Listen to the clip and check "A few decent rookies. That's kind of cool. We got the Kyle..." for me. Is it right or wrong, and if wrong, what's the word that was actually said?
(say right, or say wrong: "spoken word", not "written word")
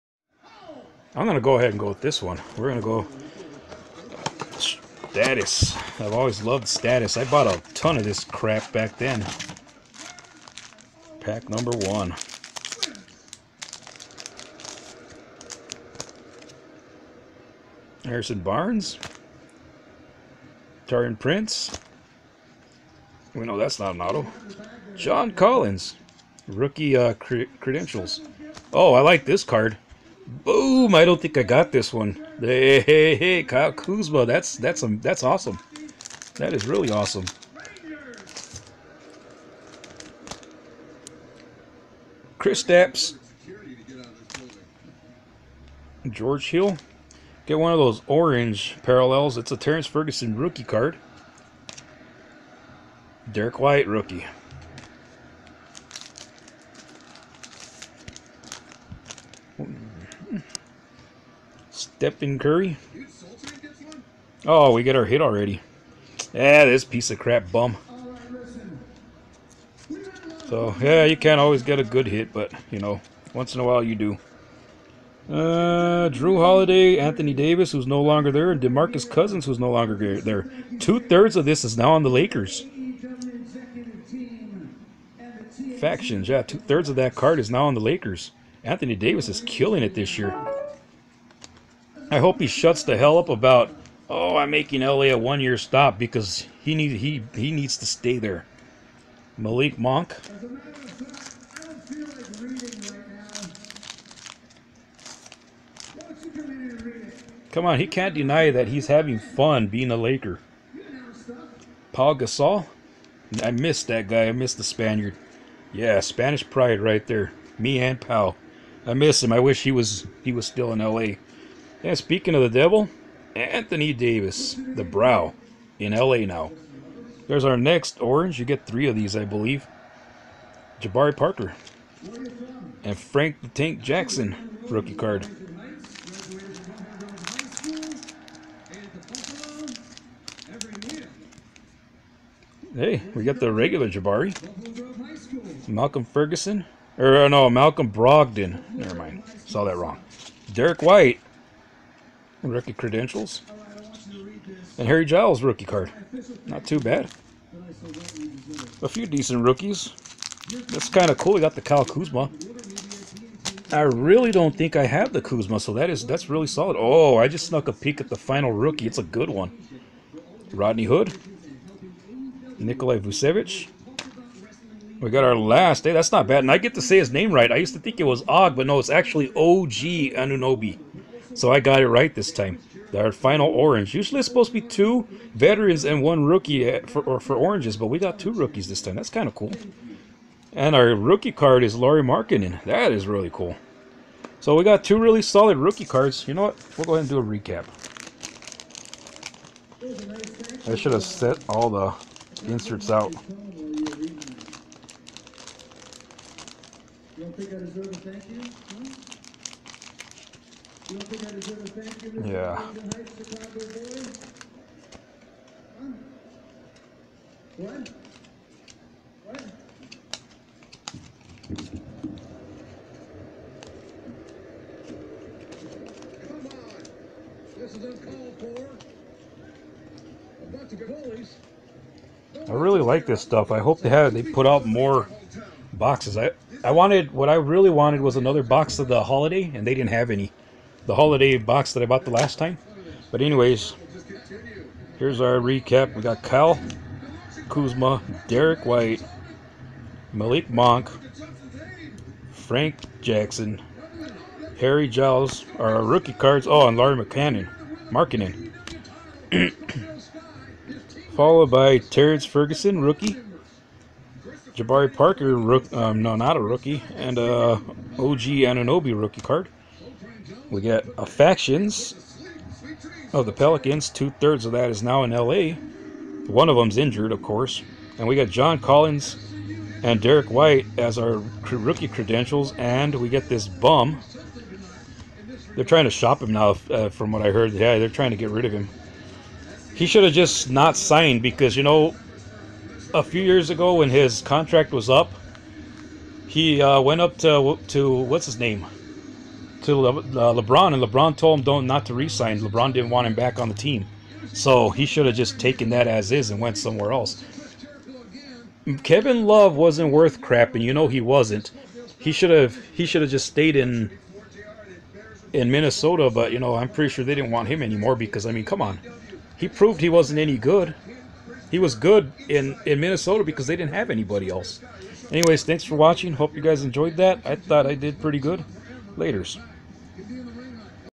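right.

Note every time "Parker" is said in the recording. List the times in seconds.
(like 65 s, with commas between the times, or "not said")
131 s, 264 s.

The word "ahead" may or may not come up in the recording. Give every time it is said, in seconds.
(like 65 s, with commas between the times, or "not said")
1 s, 196 s.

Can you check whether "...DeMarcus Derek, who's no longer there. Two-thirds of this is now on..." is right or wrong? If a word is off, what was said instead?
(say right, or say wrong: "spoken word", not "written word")
wrong: "Cousins", not "Derek".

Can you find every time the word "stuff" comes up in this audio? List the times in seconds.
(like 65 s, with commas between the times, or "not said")
233 s.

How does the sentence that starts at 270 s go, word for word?
We got affections of oh, the Pelicans.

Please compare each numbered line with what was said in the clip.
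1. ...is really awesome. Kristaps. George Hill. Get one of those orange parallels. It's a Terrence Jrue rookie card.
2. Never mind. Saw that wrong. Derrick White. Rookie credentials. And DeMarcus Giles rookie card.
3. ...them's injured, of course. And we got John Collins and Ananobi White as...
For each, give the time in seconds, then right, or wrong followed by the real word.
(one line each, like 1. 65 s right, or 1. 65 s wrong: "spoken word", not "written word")
1. 36 s wrong: "Ferguson", not "Jrue"
2. 148 s wrong: "Harry", not "DeMarcus"
3. 276 s wrong: "Derrick", not "Ananobi".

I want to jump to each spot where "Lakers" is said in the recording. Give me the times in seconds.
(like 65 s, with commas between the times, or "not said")
82 s, 87 s, 109 s.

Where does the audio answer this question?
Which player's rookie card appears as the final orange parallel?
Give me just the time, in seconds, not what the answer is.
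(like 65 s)
191 s.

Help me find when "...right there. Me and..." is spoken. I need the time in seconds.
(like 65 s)
116 s.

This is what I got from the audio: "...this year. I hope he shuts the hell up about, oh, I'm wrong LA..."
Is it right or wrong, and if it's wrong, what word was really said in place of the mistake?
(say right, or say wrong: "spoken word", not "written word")
wrong: "making", not "wrong".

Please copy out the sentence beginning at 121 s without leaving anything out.
And speaking of the devil, Anthony Davis, the brow, in LA now.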